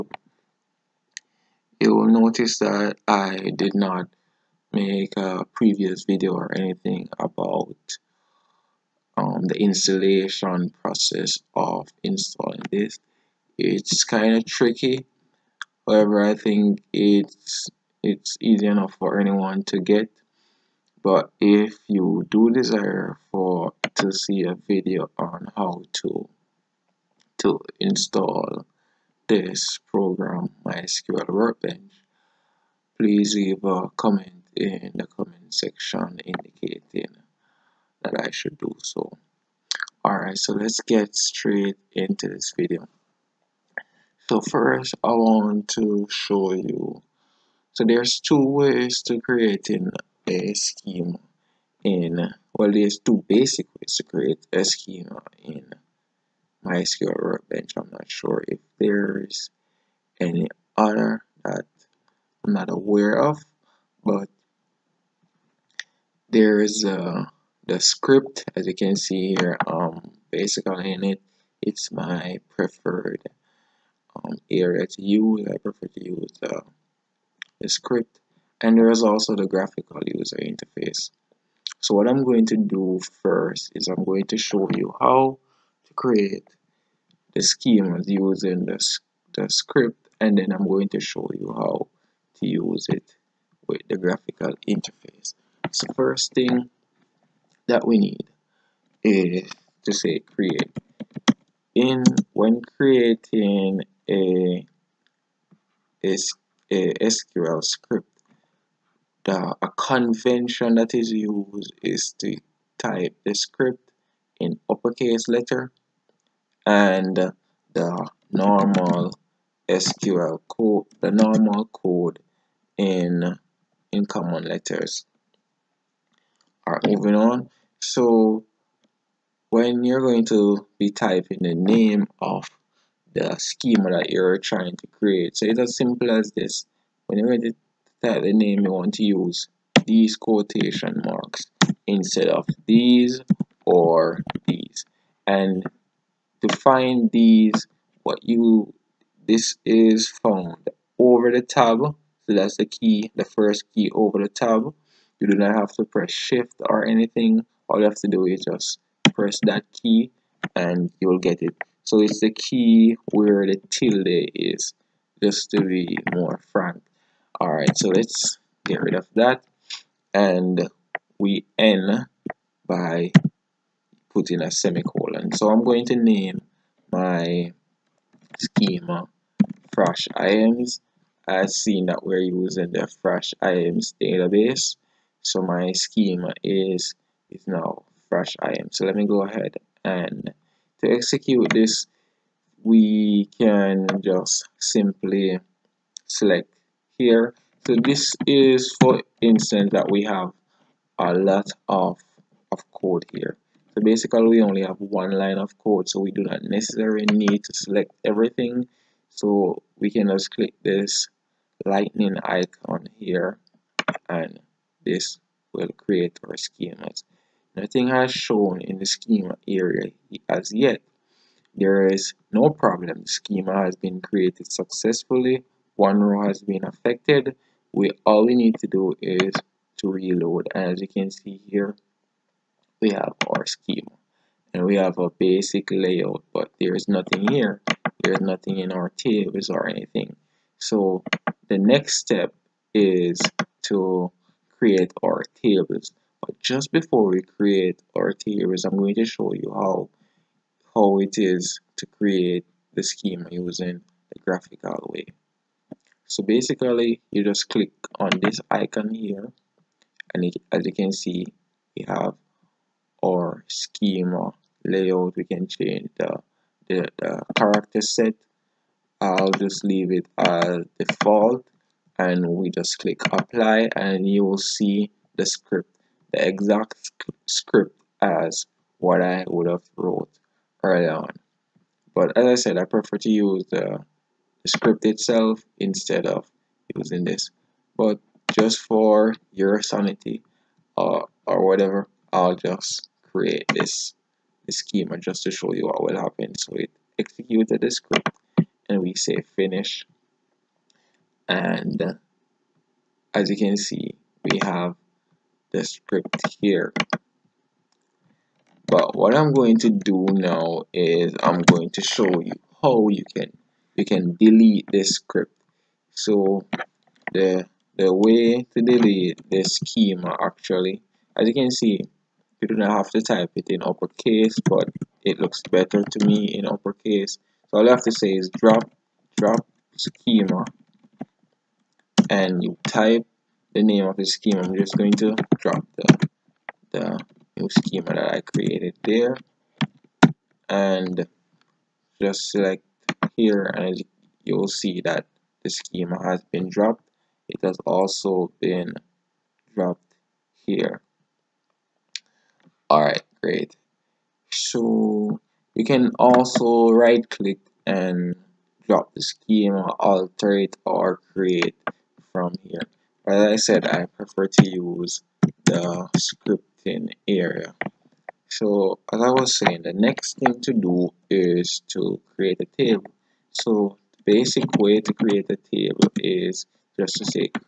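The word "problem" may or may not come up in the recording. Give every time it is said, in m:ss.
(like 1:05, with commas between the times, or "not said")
3:42.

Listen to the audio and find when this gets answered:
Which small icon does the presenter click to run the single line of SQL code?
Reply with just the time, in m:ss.
3:31.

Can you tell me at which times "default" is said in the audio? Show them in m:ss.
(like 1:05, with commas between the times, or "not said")
4:30.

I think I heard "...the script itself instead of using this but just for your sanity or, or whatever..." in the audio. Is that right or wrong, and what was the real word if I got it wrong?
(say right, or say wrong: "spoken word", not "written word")
right.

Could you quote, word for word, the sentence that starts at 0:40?
Alright, so let's get straight into this video.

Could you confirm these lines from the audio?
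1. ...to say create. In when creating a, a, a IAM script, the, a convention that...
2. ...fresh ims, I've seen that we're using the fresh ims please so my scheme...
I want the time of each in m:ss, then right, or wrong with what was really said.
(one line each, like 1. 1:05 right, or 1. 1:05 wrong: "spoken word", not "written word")
1. 1:39 wrong: "SQL", not "IAM"
2. 2:59 wrong: "database", not "please".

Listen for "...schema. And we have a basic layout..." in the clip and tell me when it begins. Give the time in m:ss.
3:53.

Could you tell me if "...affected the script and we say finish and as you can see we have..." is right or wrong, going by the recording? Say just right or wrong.
wrong.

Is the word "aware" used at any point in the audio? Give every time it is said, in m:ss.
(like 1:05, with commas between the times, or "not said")
1:02.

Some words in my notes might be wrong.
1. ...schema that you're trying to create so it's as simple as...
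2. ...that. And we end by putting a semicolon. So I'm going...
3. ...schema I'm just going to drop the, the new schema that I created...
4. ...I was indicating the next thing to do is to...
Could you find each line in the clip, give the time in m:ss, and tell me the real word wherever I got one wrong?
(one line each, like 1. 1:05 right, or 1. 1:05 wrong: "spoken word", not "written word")
1. 2:13 right
2. 2:49 right
3. 5:34 right
4. 6:08 wrong: "saying", not "indicating".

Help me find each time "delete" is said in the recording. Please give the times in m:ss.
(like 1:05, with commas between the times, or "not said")
5:14, 5:18.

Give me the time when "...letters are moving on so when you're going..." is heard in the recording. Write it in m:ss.
2:04.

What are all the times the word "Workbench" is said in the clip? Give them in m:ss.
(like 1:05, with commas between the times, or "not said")
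0:31, 0:57.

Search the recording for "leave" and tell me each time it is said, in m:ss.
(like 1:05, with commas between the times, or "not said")
0:33, 4:29.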